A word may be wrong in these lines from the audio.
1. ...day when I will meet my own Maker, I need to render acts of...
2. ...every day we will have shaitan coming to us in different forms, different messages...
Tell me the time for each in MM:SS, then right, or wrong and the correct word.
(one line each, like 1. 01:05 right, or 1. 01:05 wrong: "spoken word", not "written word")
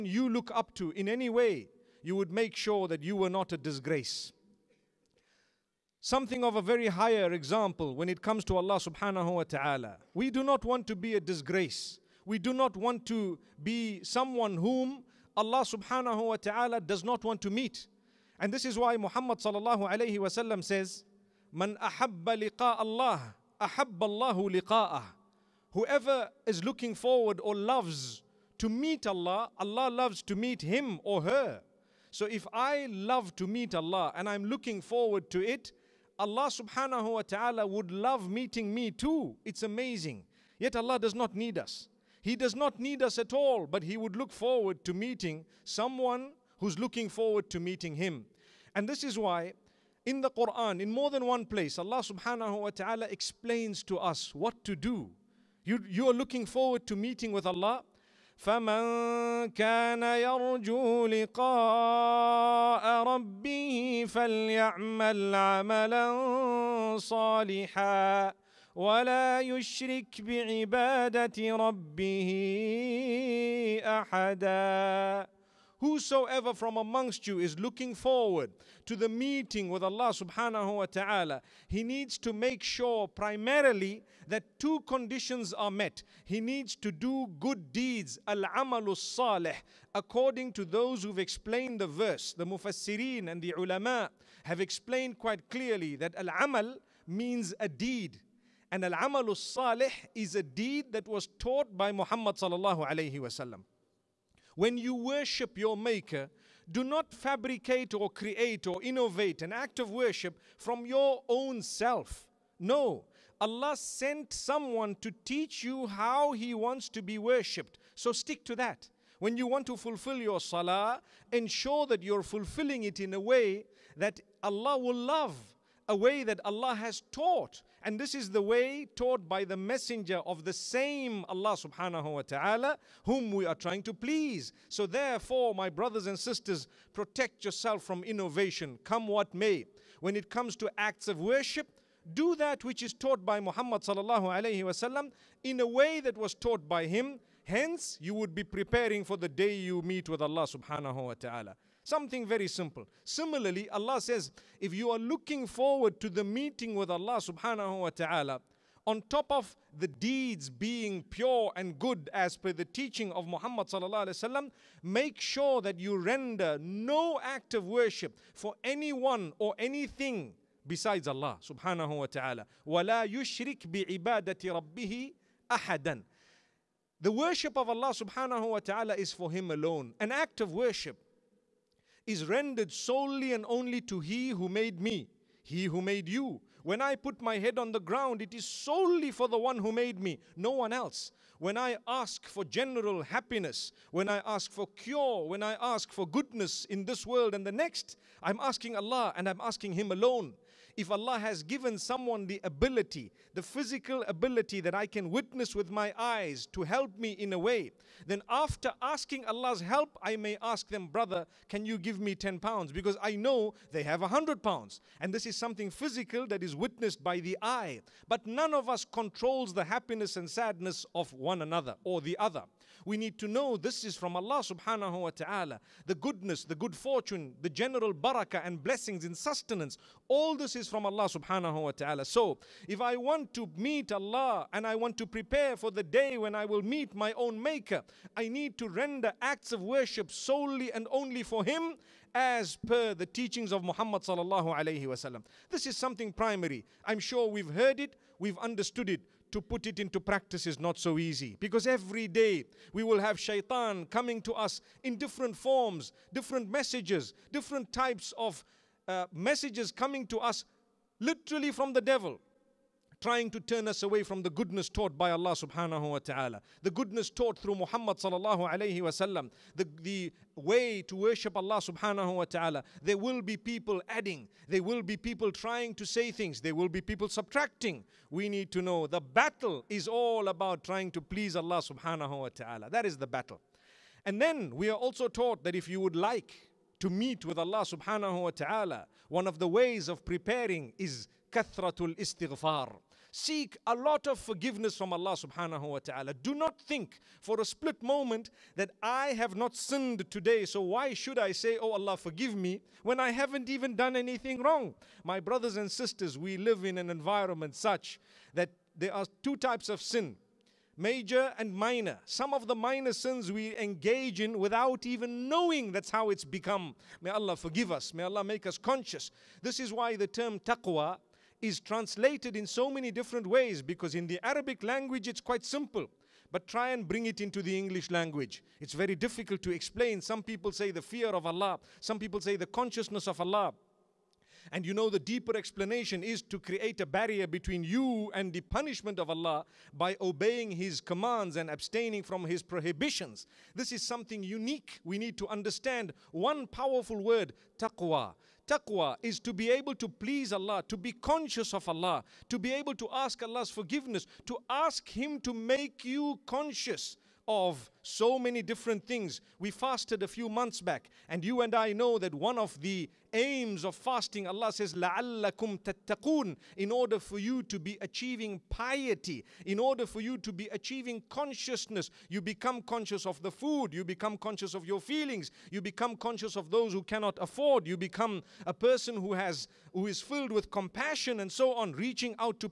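1. 03:55 right
2. 04:11 right.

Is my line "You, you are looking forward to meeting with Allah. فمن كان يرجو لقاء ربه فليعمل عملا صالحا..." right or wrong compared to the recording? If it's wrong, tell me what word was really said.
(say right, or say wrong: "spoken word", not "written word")
right.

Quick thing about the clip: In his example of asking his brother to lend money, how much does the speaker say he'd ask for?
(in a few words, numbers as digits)
10 pounds.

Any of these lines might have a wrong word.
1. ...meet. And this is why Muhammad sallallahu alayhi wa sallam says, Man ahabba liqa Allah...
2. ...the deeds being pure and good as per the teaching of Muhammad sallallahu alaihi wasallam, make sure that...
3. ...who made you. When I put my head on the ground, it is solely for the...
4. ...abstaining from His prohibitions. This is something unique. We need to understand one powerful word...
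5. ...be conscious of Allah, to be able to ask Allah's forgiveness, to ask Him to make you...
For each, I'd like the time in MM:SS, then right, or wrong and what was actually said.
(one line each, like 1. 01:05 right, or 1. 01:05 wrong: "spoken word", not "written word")
1. 00:17 right
2. 02:39 right
3. 03:05 right
4. 05:41 right
5. 05:50 right.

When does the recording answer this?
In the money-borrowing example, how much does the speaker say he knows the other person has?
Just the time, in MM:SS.
03:34.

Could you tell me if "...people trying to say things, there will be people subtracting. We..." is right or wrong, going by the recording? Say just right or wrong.
right.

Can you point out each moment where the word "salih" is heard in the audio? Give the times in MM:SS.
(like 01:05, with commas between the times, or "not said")
01:28, 01:39.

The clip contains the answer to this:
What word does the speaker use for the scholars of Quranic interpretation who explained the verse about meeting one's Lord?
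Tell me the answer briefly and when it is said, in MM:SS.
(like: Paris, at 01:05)
mufassirin, at 01:32.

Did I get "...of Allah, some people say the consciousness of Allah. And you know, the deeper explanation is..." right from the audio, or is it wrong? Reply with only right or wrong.
right.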